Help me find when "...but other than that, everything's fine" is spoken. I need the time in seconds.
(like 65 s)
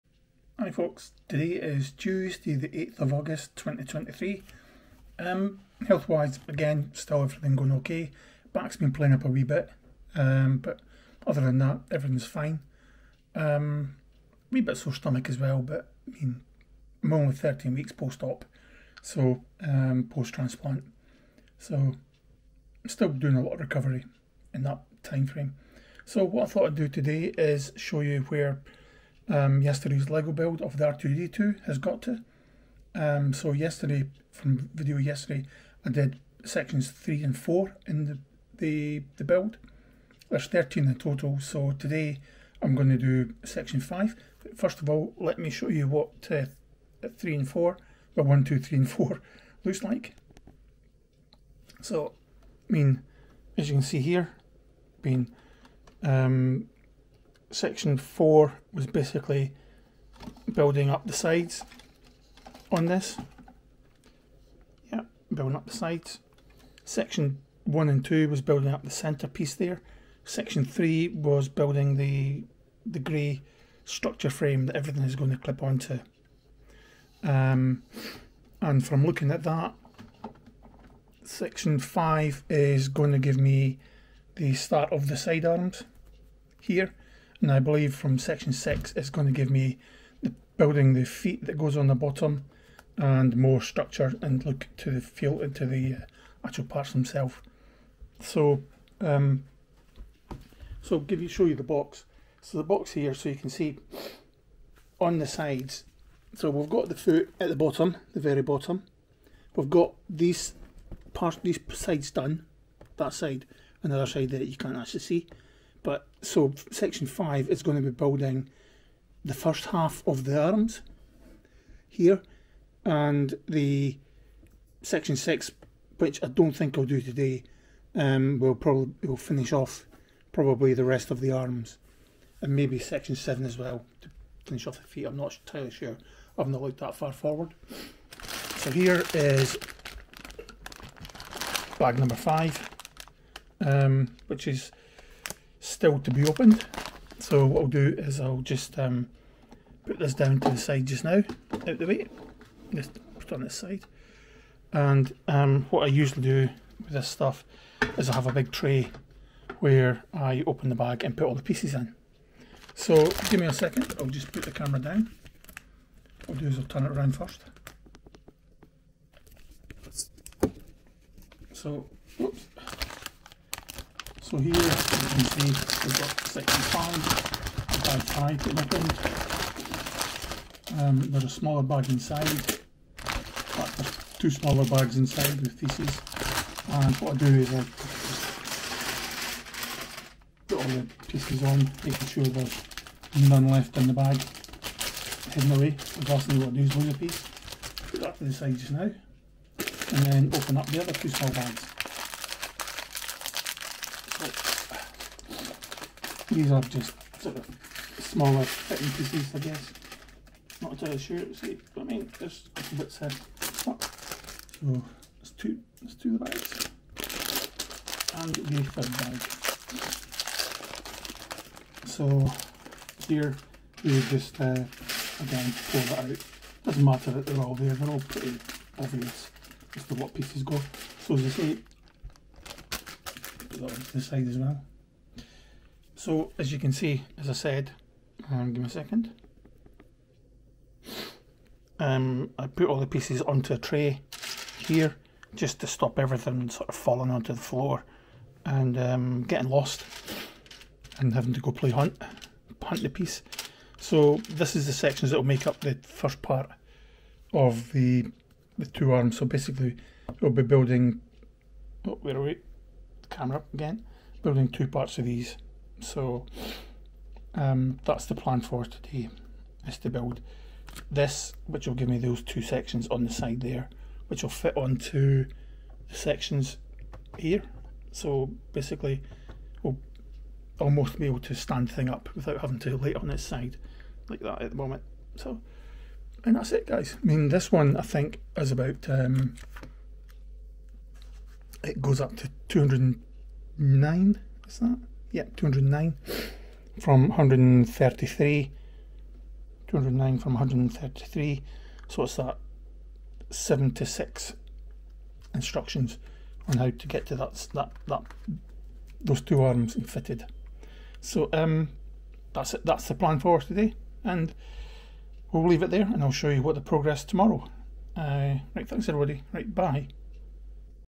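10 s.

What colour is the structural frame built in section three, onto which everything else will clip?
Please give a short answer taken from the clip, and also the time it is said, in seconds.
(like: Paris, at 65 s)
Grey, at 72 s.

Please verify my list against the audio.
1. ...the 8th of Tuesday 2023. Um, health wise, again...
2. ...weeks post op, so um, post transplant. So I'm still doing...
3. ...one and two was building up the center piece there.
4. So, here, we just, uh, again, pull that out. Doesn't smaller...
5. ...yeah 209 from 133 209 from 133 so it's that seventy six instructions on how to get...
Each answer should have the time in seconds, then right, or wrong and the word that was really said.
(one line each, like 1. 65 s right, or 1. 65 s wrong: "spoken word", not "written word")
1. 2 s wrong: "August", not "Tuesday"
2. 17 s right
3. 67 s right
4. 221 s wrong: "matter", not "smaller"
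5. 295 s right.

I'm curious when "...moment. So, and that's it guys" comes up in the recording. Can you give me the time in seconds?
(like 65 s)
284 s.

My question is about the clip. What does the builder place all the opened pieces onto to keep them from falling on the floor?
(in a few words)
A big tray.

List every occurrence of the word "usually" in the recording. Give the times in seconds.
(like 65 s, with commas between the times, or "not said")
155 s.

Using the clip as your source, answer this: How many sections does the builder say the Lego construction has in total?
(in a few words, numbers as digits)
13.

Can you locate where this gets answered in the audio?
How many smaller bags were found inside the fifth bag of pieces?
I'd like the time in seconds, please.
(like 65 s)
184 s.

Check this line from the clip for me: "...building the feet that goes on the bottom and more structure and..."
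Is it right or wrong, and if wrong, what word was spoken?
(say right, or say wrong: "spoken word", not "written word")
right.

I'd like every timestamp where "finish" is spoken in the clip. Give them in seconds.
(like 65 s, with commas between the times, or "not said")
129 s, 134 s.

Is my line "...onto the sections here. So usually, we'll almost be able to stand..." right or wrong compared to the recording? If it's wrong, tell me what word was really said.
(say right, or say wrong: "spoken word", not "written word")
wrong: "basically", not "usually".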